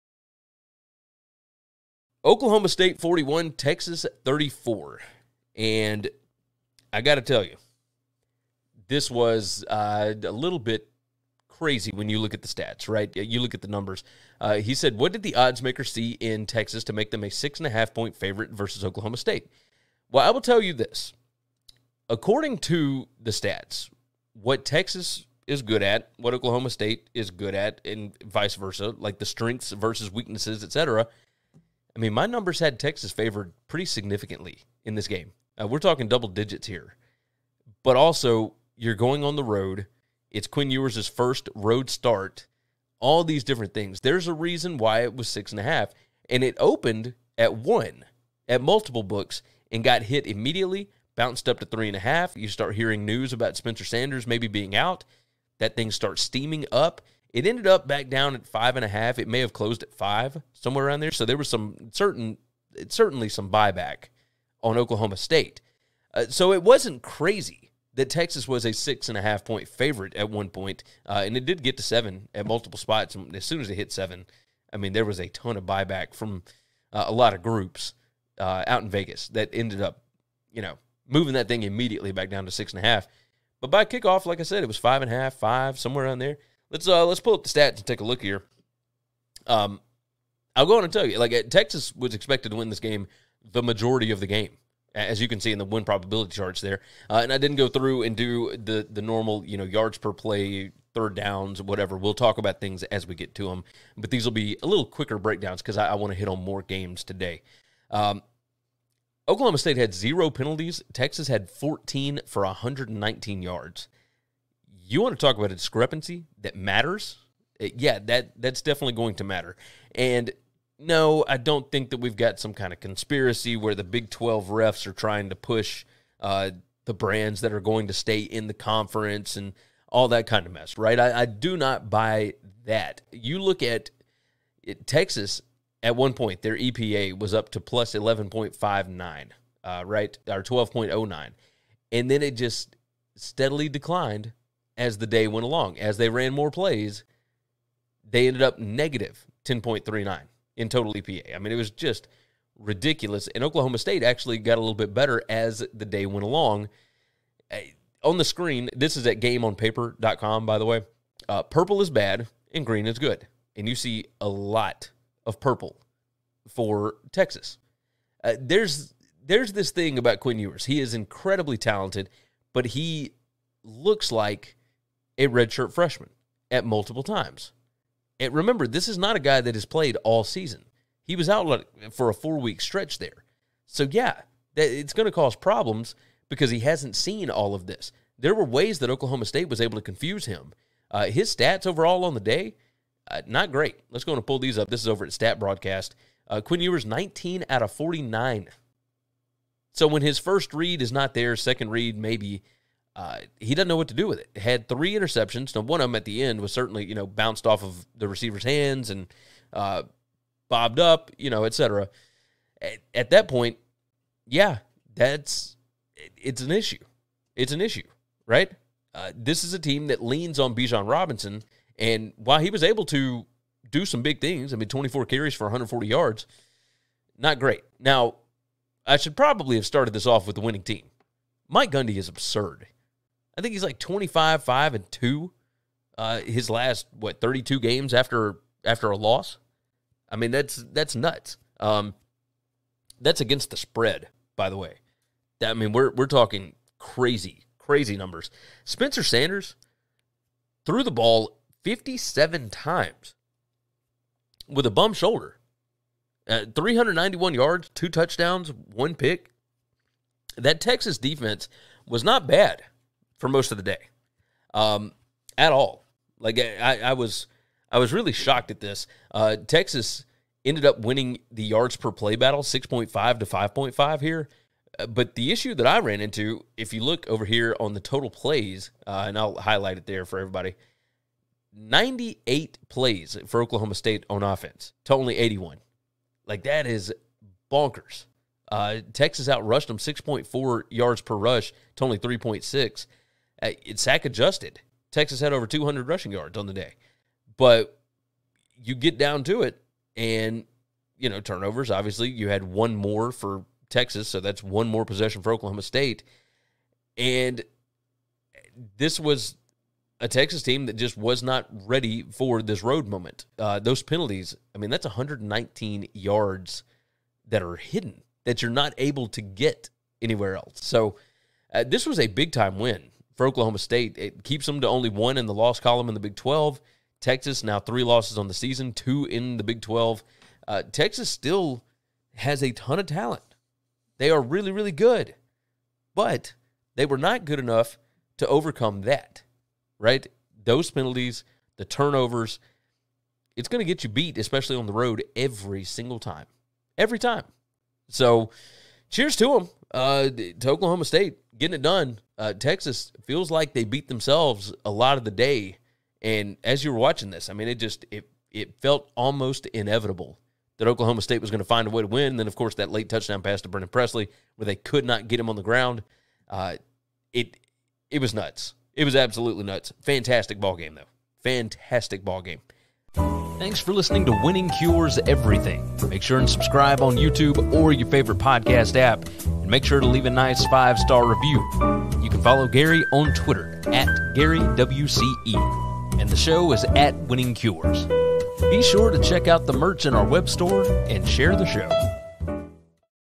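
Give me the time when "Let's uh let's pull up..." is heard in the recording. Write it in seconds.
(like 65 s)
86 s.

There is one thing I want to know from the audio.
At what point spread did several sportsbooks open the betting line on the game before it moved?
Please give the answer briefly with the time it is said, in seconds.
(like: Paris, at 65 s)
1, at 46 s.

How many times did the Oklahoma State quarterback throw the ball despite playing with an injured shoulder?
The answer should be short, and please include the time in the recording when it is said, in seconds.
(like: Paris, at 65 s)
57, at 251 s.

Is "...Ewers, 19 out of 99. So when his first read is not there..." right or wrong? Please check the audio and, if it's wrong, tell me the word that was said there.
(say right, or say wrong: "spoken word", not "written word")
wrong: "49", not "99".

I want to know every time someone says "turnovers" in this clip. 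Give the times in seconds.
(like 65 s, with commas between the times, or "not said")
301 s, 341 s.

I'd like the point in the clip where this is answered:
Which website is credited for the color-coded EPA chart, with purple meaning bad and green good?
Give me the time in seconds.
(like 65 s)
159 s.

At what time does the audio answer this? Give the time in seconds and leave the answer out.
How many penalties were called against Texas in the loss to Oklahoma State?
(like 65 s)
110 s.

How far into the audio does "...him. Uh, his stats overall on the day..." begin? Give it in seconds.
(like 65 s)
190 s.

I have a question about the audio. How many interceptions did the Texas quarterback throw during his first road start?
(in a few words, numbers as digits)
3.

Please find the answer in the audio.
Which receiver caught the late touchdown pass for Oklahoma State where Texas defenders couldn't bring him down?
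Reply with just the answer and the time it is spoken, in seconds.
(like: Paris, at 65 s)
Brennan Presley, at 363 s.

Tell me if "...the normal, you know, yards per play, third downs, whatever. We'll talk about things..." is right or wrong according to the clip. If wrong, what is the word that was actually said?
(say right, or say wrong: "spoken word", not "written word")
right.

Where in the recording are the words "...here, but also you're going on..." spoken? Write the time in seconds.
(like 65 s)
36 s.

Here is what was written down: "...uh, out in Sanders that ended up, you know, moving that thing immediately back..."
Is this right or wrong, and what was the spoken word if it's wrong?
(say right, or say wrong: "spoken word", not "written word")
wrong: "Vegas", not "Sanders".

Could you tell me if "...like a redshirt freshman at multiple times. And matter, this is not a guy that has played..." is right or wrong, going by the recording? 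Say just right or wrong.
wrong.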